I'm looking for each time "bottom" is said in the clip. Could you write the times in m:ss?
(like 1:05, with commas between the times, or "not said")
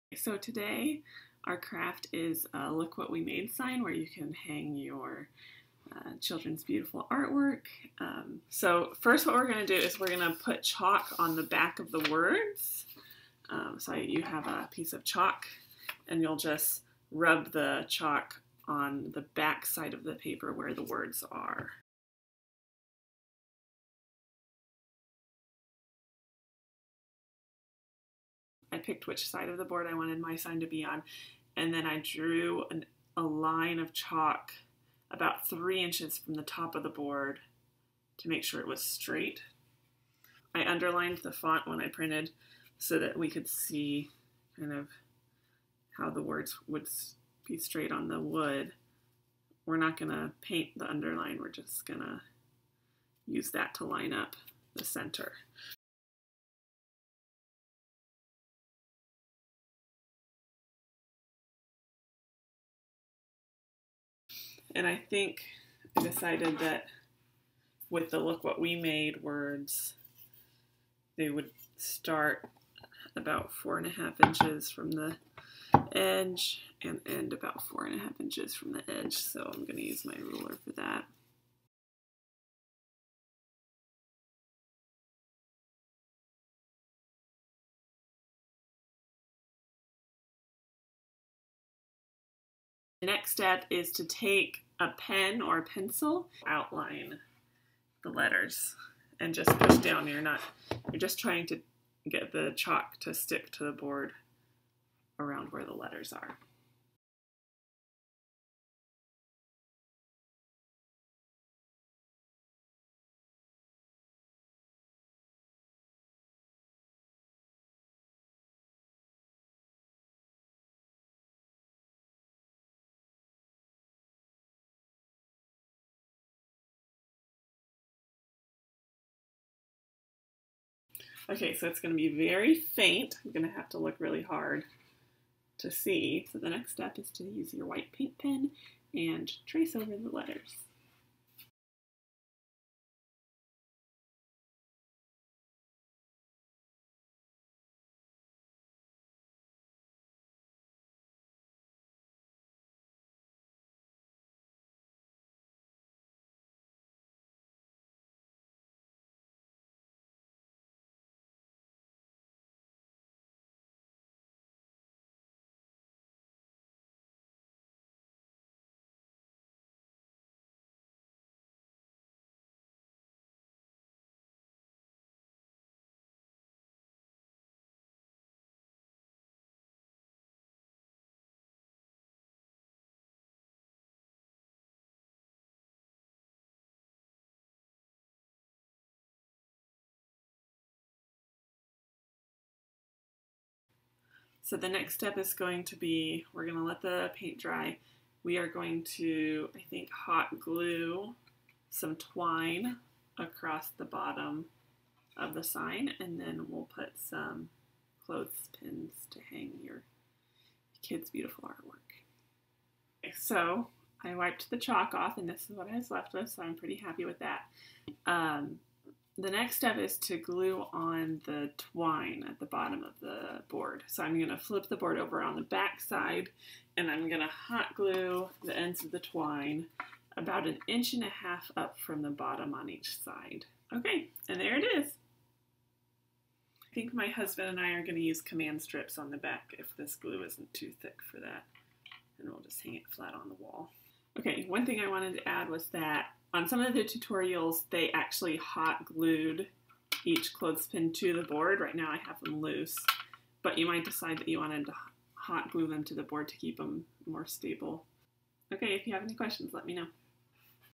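3:23, 3:42, 3:52.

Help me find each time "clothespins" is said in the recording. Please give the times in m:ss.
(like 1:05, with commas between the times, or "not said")
3:28, 4:10.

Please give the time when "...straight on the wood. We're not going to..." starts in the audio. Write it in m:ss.
0:47.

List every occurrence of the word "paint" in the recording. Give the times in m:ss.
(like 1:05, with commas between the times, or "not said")
0:50, 2:17, 3:17.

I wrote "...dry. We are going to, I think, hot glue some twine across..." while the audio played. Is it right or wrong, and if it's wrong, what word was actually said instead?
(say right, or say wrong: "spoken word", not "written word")
right.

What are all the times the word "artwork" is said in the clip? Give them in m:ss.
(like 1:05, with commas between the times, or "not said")
0:07, 3:31.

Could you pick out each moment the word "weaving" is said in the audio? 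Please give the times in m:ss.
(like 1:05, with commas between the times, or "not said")
not said.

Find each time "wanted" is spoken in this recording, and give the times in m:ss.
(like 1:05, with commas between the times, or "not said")
0:29, 4:04, 4:14.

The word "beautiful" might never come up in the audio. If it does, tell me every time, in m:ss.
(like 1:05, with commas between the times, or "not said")
0:06, 3:31.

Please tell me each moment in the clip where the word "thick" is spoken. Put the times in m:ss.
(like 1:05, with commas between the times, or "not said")
4:00.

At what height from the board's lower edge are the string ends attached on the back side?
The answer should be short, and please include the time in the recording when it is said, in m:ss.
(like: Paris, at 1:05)
1.5 inches, at 3:50.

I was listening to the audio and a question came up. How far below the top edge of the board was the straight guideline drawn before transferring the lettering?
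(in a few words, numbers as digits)
3 inches.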